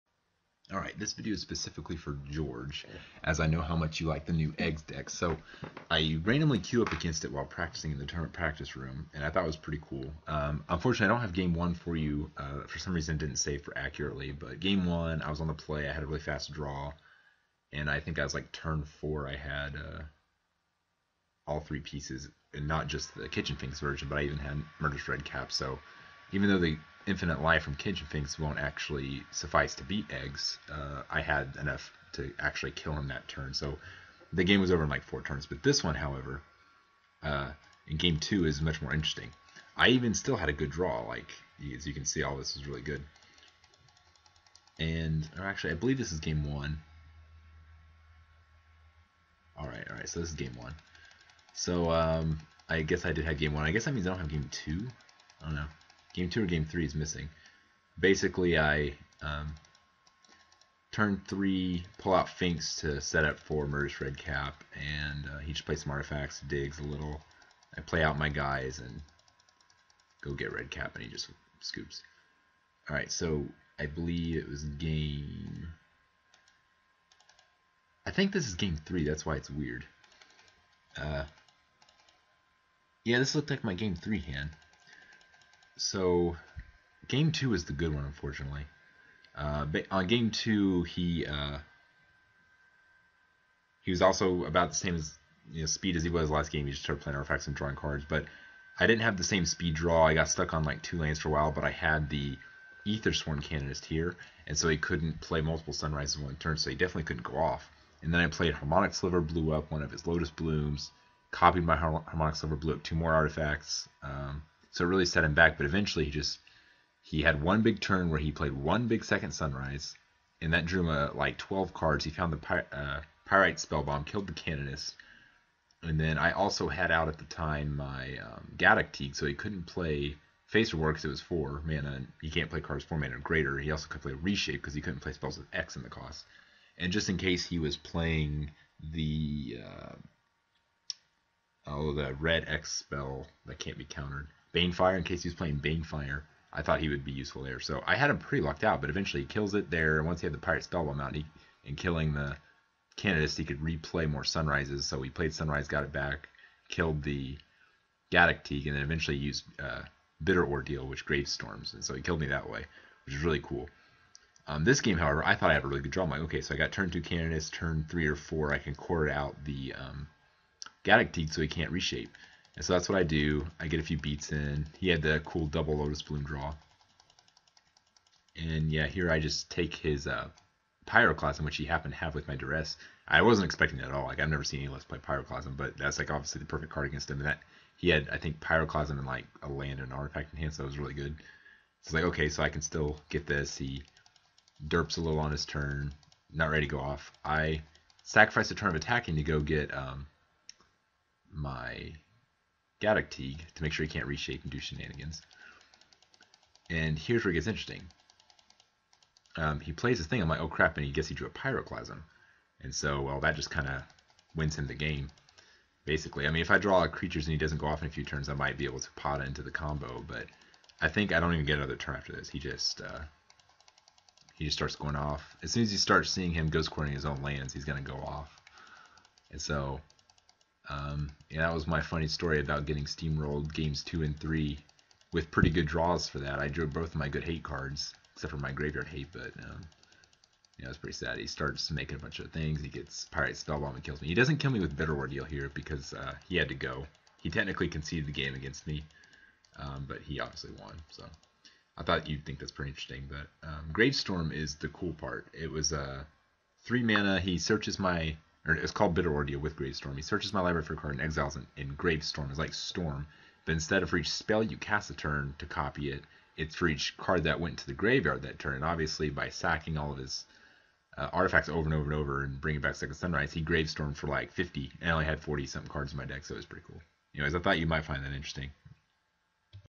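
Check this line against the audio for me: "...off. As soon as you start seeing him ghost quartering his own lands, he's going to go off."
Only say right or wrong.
right.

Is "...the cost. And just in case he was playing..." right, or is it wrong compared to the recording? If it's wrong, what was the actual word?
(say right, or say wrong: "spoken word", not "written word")
right.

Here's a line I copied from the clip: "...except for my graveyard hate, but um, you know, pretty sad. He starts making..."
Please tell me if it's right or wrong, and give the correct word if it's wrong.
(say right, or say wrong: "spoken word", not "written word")
right.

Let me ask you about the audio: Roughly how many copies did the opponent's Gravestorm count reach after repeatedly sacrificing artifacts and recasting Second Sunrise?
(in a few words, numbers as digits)
50.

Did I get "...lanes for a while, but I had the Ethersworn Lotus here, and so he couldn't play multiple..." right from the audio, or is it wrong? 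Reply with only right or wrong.
wrong.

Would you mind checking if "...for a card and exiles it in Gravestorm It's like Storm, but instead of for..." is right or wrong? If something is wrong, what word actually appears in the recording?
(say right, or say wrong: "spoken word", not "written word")
right.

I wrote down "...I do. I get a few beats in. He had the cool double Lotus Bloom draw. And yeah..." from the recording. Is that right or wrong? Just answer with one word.
right.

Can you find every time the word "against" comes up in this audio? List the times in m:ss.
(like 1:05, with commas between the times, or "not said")
0:06, 3:06, 4:08.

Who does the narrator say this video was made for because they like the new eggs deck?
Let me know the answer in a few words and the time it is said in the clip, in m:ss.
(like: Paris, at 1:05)
George, at 0:02.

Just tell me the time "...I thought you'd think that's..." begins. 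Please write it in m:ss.
4:11.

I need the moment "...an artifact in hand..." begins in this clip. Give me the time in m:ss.
3:09.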